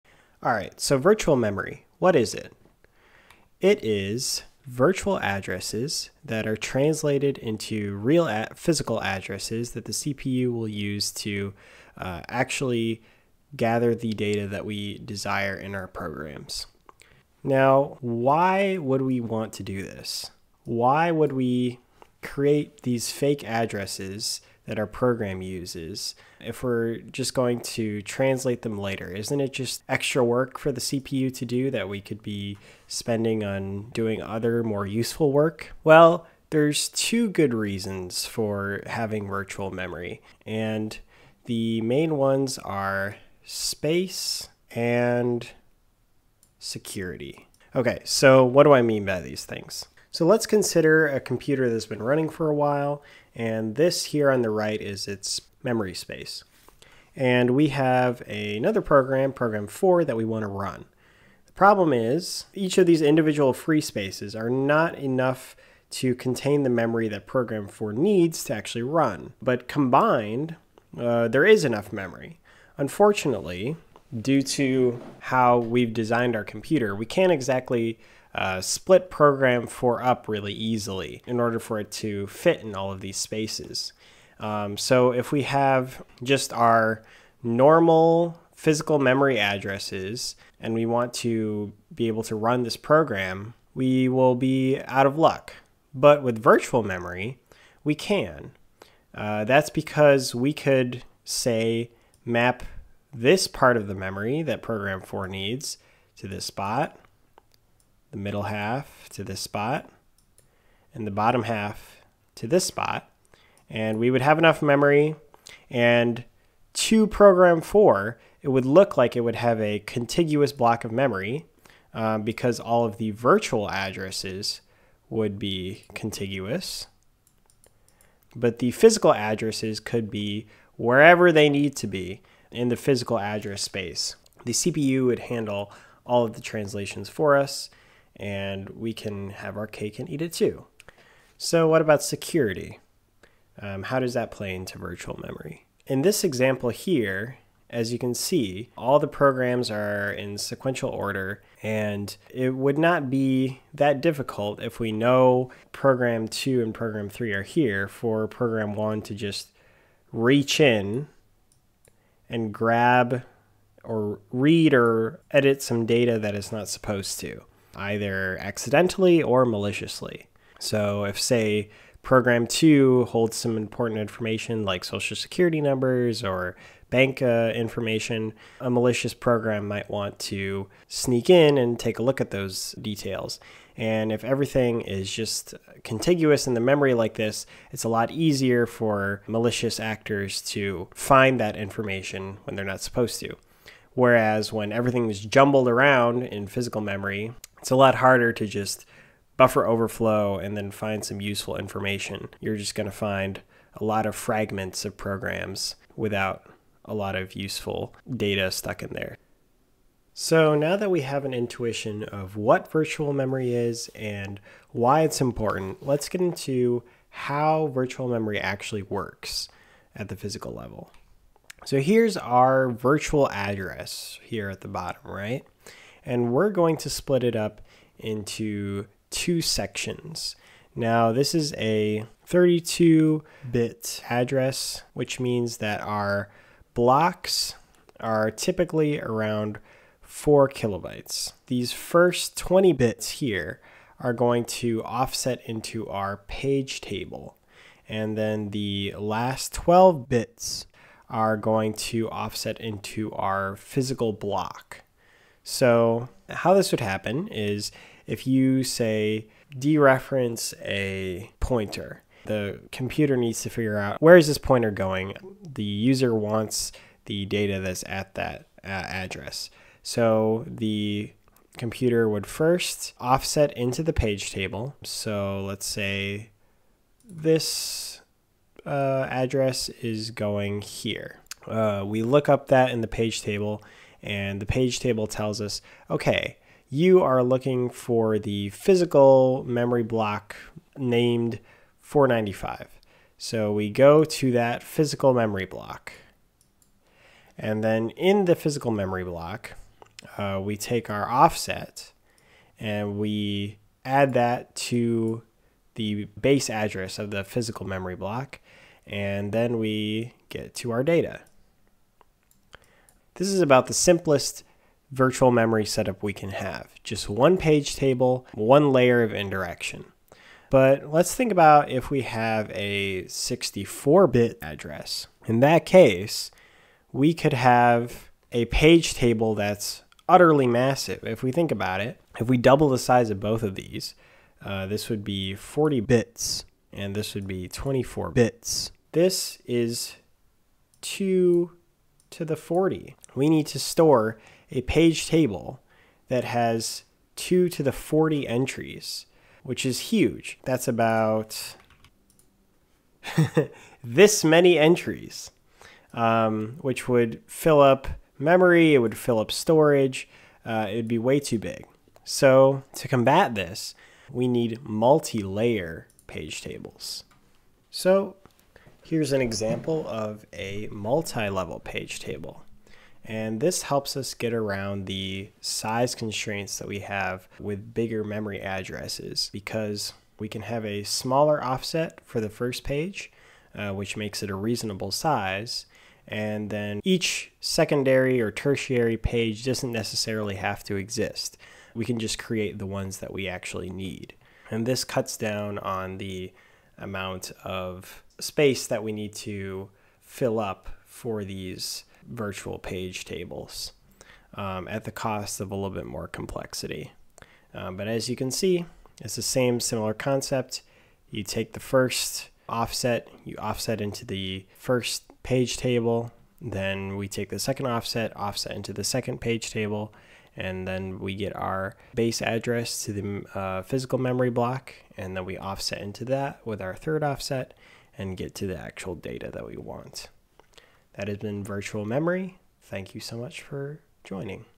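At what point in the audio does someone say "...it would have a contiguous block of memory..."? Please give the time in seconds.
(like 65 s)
119 s.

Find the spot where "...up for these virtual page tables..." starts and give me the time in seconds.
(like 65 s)
400 s.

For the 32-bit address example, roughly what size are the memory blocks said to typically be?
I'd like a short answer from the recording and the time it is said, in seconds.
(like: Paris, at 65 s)
4 kilobytes, at 240 s.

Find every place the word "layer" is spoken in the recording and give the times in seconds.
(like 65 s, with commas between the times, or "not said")
318 s, 364 s.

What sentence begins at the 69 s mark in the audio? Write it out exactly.
But combined, uh, there is enough memory.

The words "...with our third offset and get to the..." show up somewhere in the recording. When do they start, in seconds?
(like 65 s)
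426 s.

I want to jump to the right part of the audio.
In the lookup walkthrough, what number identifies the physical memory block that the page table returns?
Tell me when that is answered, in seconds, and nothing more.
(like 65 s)
291 s.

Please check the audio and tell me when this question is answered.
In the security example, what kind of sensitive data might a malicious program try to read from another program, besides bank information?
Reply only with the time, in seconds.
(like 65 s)
174 s.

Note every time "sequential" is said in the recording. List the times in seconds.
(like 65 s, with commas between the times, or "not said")
150 s.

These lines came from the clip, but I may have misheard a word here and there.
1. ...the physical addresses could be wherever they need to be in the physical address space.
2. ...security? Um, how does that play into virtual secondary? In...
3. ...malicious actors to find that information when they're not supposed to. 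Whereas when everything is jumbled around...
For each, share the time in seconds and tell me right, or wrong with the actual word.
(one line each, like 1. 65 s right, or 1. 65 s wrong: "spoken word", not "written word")
1. 128 s right
2. 142 s wrong: "memory", not "secondary"
3. 189 s right.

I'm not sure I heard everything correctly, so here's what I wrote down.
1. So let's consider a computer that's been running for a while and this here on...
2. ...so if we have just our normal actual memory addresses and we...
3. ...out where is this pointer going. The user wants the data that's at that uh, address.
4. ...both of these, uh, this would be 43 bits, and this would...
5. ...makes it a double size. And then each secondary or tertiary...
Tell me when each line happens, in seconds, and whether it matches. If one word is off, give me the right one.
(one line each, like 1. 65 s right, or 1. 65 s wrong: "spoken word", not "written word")
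1. 50 s right
2. 84 s wrong: "physical", not "actual"
3. 263 s right
4. 333 s wrong: "40", not "43"
5. 383 s wrong: "reasonable", not "double".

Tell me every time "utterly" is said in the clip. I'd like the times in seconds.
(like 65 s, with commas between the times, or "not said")
330 s.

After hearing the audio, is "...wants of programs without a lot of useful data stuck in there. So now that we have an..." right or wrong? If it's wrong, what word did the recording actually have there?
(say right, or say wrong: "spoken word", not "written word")
wrong: "fragments", not "wants".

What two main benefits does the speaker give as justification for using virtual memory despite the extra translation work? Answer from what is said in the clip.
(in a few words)
Space and security.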